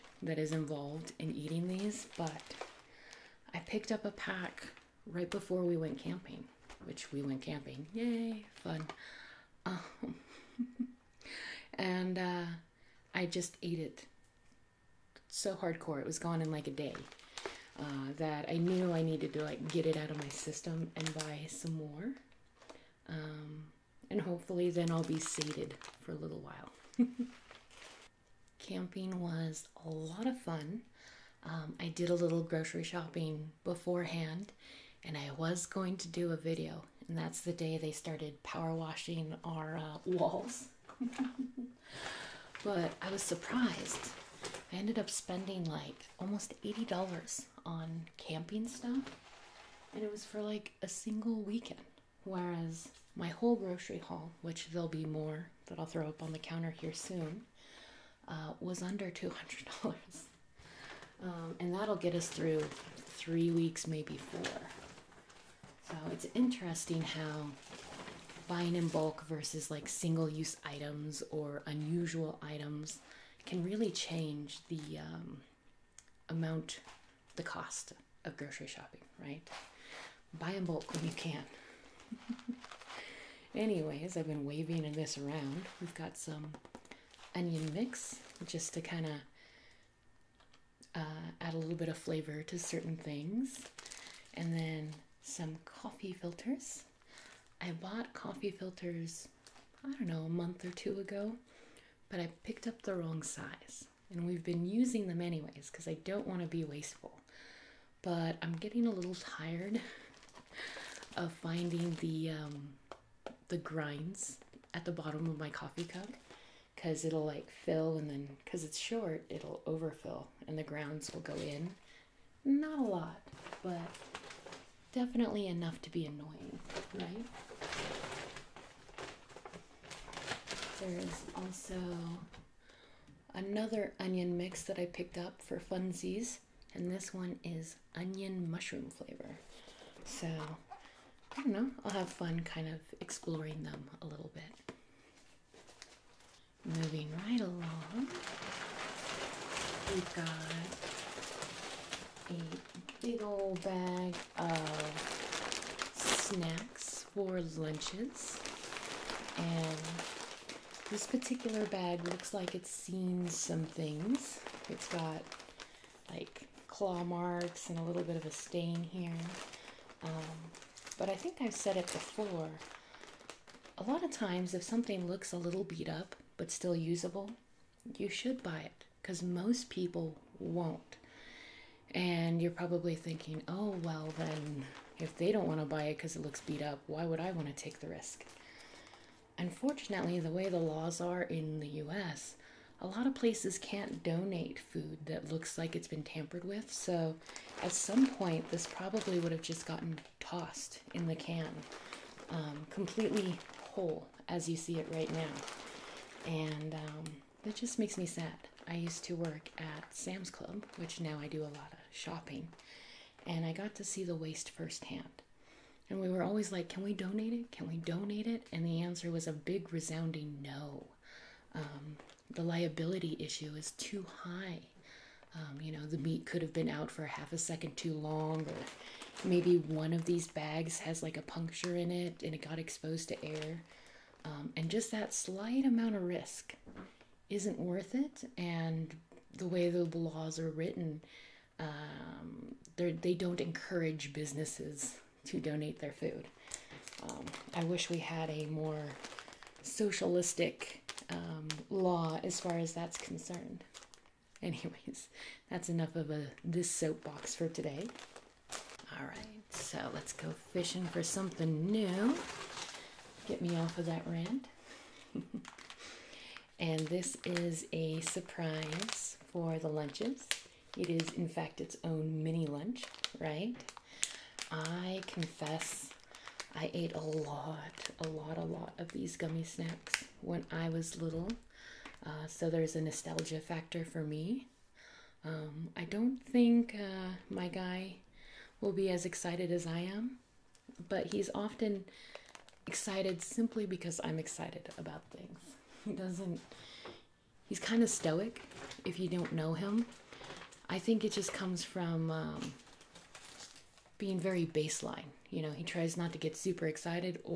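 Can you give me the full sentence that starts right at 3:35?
And we were always like, can we donate it?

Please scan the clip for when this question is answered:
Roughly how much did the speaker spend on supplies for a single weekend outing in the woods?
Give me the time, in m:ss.
0:46.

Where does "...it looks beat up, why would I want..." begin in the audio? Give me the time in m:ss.
3:06.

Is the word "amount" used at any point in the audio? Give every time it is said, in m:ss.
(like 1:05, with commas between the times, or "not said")
1:16, 3:55.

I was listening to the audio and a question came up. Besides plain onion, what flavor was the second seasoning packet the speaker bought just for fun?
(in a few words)
onion mushroom.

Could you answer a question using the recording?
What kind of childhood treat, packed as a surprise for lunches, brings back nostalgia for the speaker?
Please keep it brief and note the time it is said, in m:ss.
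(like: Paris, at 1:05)
gummy snacks, at 4:39.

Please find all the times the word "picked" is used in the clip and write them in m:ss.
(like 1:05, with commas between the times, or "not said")
0:03, 1:42, 2:14.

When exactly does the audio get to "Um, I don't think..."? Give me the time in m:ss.
4:45.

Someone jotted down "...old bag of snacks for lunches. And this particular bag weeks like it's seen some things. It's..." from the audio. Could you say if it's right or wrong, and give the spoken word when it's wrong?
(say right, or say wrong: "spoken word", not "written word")
wrong: "looks", not "weeks".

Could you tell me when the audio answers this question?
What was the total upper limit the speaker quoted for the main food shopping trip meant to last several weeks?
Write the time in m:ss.
0:59.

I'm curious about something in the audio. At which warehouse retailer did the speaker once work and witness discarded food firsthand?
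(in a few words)
Sam's Club.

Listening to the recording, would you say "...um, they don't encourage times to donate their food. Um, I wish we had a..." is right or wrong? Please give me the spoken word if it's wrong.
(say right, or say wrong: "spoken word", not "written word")
wrong: "businesses", not "times".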